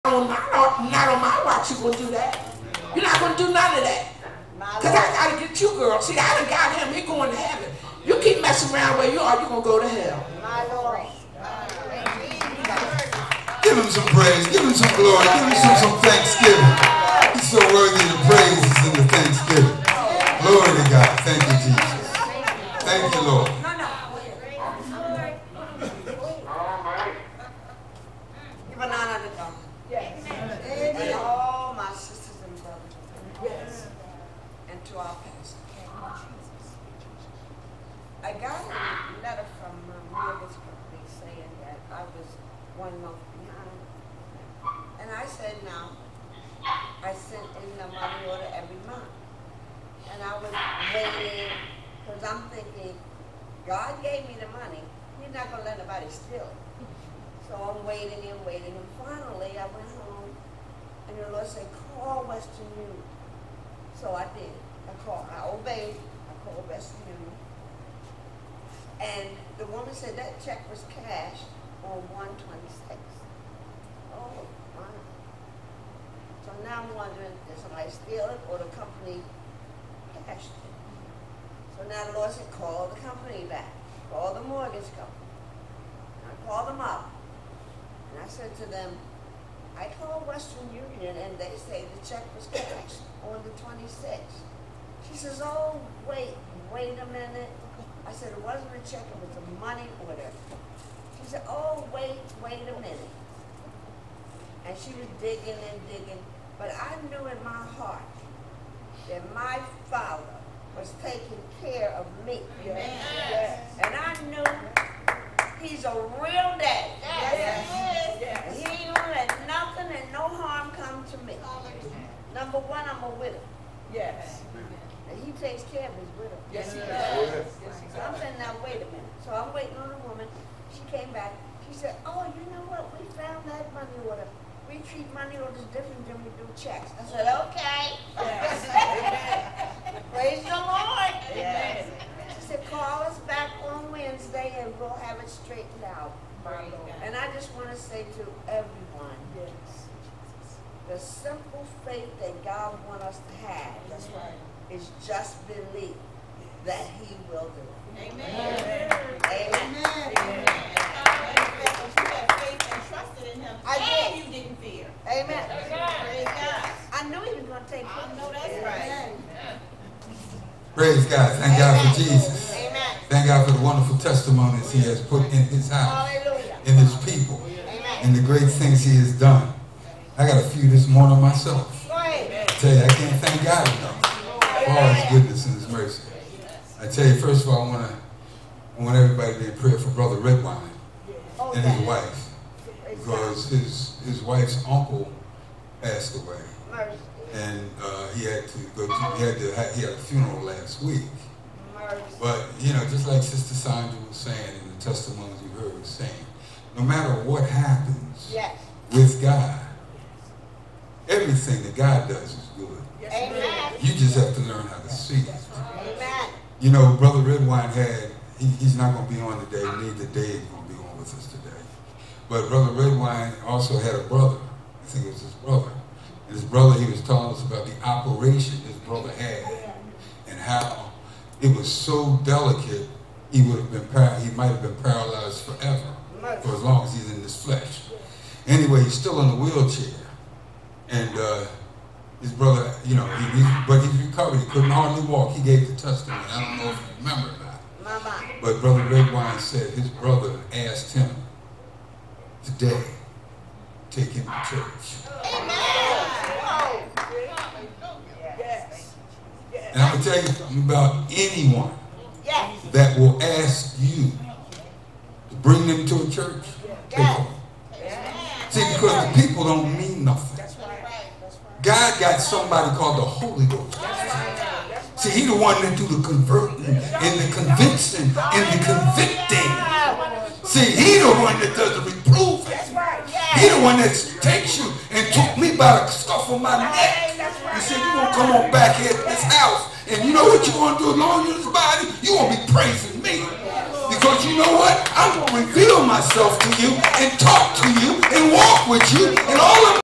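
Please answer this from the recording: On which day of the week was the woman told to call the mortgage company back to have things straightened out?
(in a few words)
Wednesday.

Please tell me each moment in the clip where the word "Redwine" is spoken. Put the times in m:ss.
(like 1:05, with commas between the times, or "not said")
3:10, 3:37, 3:42, 4:08.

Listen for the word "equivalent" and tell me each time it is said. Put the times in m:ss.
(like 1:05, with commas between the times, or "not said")
not said.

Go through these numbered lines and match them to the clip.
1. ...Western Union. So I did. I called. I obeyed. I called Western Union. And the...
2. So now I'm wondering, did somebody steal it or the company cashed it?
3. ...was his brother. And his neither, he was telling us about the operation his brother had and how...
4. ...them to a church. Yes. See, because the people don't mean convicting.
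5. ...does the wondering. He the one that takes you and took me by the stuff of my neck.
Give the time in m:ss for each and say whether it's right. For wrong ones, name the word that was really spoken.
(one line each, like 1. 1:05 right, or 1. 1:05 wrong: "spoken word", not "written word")
1. 1:02 right
2. 1:16 right
3. 3:45 wrong: "brother", not "neither"
4. 4:25 wrong: "nothing", not "convicting"
5. 4:41 wrong: "reproving", not "wondering".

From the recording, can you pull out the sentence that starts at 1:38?
I said, it wasn't a check, it was a money order.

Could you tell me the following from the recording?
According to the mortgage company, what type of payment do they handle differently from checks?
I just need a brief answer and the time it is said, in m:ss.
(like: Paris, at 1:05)
Money orders, at 2:15.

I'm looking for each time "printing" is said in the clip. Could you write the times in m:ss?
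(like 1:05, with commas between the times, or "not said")
not said.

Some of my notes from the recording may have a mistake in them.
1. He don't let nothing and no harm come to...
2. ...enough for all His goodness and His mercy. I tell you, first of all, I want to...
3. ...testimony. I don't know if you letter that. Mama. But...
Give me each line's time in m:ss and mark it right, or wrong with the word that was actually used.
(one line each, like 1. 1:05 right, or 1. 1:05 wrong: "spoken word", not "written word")
1. 1:58 right
2. 3:03 right
3. 4:05 wrong: "remember", not "letter".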